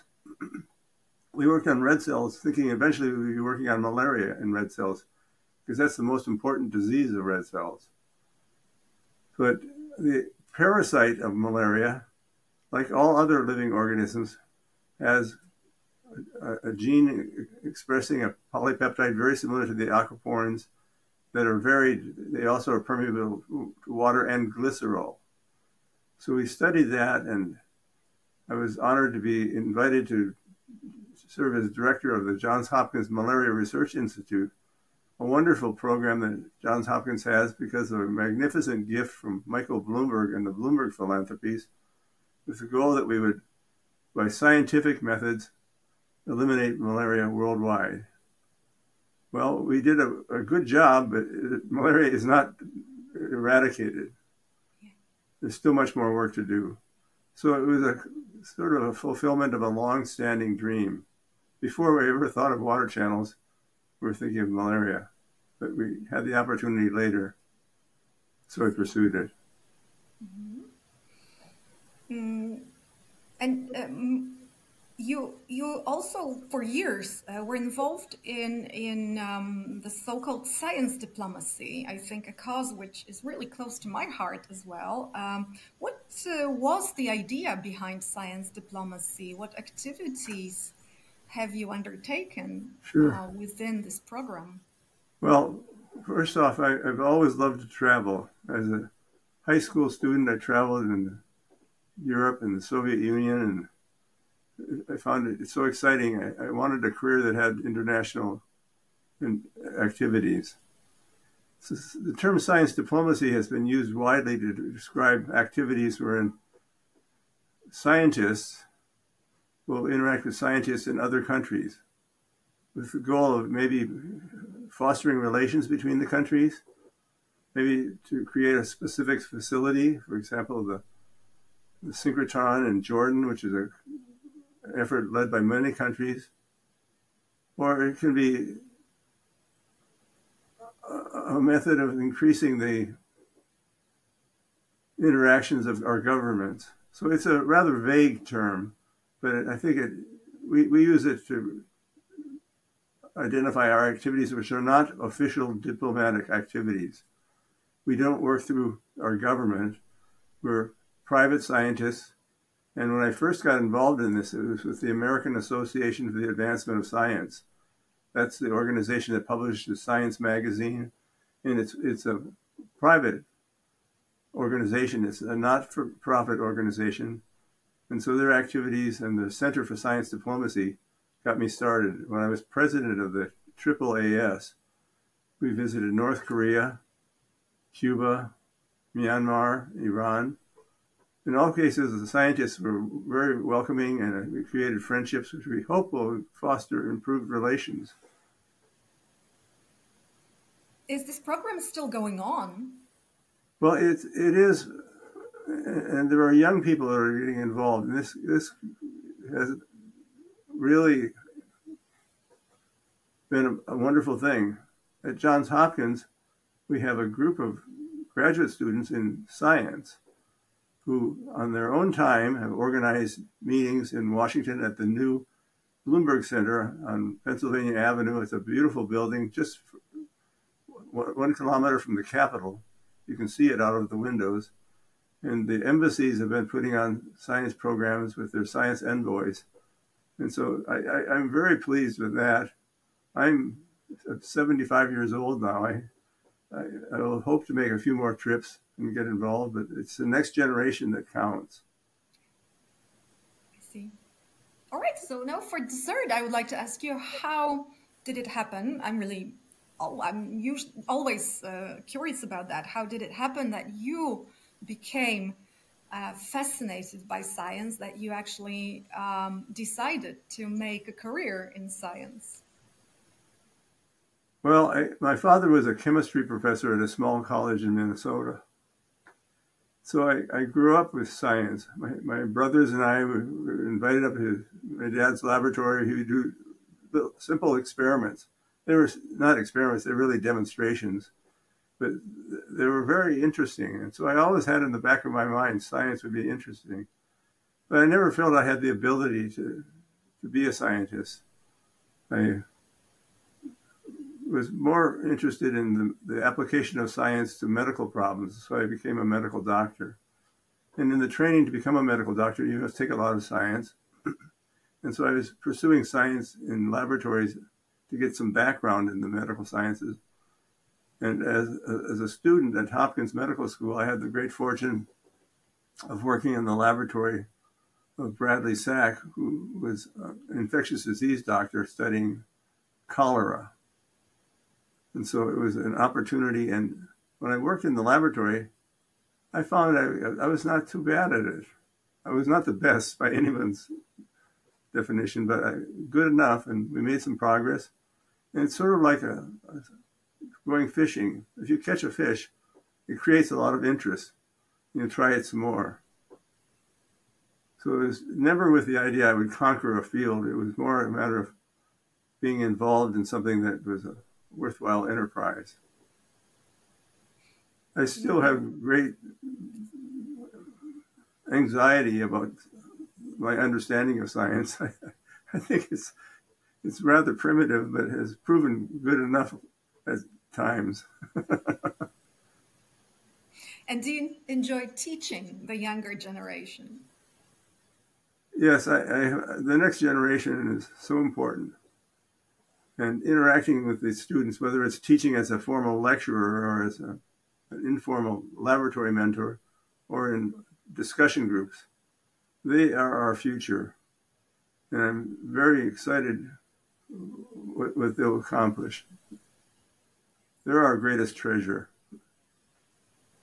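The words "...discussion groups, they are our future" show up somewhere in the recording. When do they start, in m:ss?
6:40.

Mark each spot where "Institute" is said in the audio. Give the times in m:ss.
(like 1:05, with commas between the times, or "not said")
0:33.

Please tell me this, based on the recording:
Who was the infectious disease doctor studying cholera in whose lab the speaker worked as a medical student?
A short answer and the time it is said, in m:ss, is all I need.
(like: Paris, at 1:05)
Bradley Sack, at 5:28.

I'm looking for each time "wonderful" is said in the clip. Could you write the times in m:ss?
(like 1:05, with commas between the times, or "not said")
0:35, 3:33.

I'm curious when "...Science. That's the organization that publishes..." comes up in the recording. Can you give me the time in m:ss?
2:46.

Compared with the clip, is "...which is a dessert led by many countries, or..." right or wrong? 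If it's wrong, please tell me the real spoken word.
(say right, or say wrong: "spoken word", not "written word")
wrong: "effort", not "dessert".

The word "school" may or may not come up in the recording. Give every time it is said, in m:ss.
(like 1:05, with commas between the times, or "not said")
1:39, 5:23.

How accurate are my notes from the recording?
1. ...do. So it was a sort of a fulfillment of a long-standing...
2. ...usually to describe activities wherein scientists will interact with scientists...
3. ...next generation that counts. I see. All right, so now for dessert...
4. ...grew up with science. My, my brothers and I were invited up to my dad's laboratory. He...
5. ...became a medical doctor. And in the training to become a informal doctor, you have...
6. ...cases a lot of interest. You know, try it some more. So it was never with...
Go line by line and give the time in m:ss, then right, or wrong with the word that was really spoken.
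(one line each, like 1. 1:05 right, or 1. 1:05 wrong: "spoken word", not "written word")
1. 0:56 right
2. 1:53 wrong: "widely", not "usually"
3. 4:10 right
4. 4:40 right
5. 5:08 wrong: "medical", not "informal"
6. 5:52 wrong: "creates", not "cases".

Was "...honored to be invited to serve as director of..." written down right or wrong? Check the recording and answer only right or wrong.
right.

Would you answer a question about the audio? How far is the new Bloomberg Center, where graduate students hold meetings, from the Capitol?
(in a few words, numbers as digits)
1 kilometer.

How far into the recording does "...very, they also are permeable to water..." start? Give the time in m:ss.
0:21.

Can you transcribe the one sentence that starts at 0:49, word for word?
Well, we did a, a good job, but malaria is not eradicated.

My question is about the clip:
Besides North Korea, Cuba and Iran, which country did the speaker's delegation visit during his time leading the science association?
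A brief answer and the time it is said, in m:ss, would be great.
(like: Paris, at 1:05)
Myanmar, at 3:08.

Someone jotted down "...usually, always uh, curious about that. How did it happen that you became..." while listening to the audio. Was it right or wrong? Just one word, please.
right.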